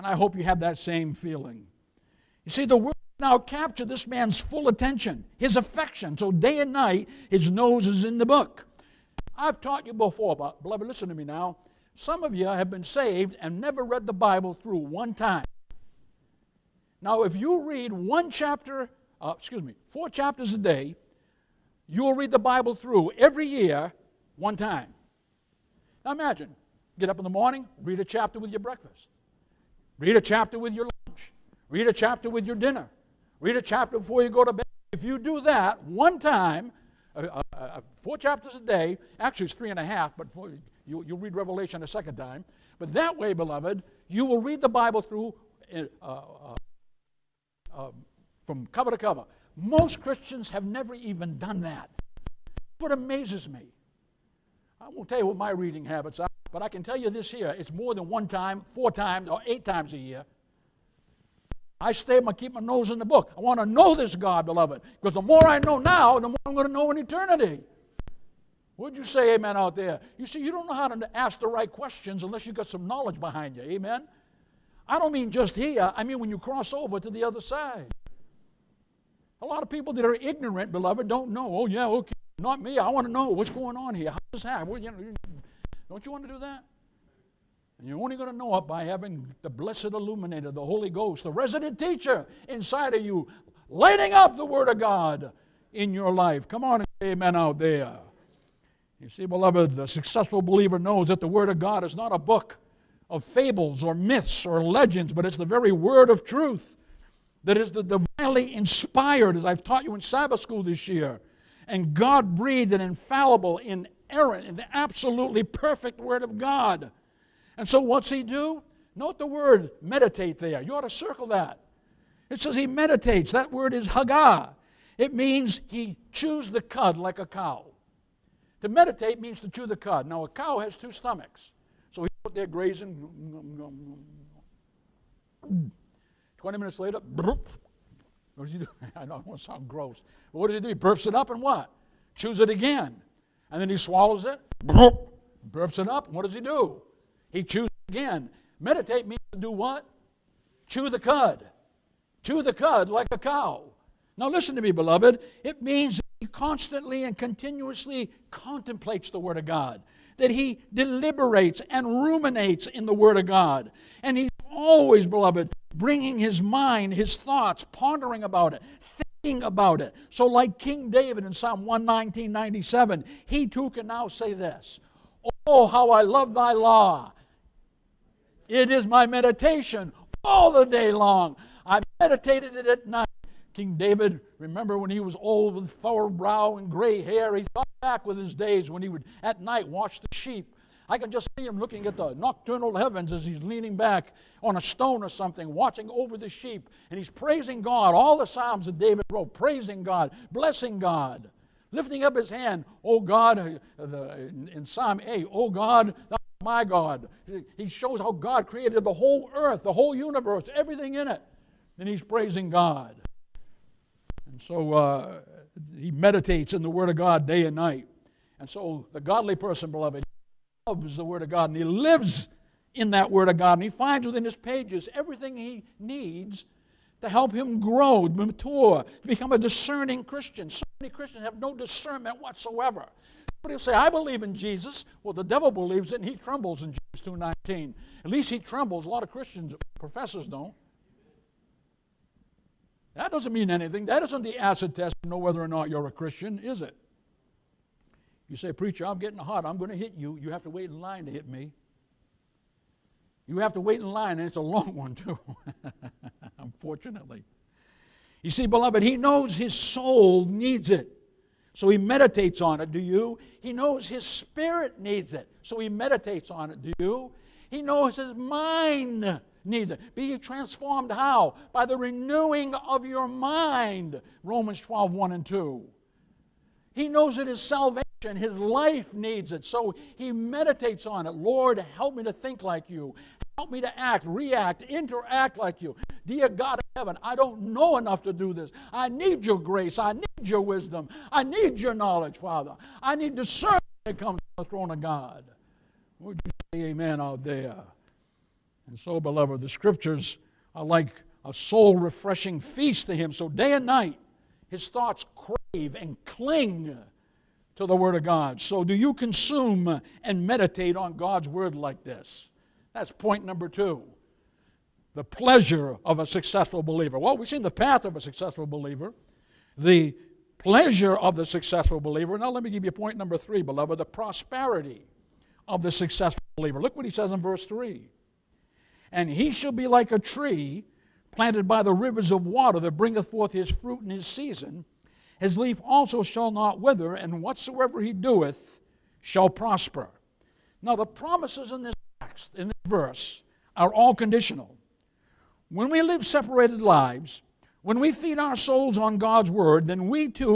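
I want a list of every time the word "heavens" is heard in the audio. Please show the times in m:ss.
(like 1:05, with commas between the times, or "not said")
3:12, 4:46.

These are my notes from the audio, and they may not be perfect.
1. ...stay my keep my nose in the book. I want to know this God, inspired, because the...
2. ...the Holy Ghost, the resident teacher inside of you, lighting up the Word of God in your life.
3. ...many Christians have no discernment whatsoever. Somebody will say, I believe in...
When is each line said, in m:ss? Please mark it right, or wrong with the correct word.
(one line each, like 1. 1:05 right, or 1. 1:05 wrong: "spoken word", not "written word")
1. 1:01 wrong: "beloved", not "inspired"
2. 1:30 right
3. 3:50 right.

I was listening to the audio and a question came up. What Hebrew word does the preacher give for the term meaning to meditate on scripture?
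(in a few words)
haggah.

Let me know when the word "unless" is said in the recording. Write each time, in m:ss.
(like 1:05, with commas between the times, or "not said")
1:12.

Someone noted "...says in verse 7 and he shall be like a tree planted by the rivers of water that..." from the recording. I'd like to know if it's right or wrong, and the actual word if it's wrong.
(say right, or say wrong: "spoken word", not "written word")
wrong: "3", not "7".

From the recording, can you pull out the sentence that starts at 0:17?
Now, if you read one chapter, uh, excuse me, four chapters a day, you'll read the Bible through every year one time.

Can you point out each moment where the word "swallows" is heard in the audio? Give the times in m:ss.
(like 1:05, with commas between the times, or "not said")
2:23.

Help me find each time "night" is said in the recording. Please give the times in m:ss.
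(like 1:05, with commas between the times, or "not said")
0:06, 3:02, 3:09, 3:37, 5:03.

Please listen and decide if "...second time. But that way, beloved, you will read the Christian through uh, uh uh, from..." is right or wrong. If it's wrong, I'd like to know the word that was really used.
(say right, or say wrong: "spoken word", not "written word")
wrong: "Bible", not "Christian".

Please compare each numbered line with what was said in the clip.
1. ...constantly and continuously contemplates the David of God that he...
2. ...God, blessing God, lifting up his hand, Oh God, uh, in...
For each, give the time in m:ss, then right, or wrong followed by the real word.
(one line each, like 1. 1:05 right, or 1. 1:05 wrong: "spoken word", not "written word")
1. 2:36 wrong: "Word", not "David"
2. 3:19 right.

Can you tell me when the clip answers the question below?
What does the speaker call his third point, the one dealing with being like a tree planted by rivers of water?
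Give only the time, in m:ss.
5:23.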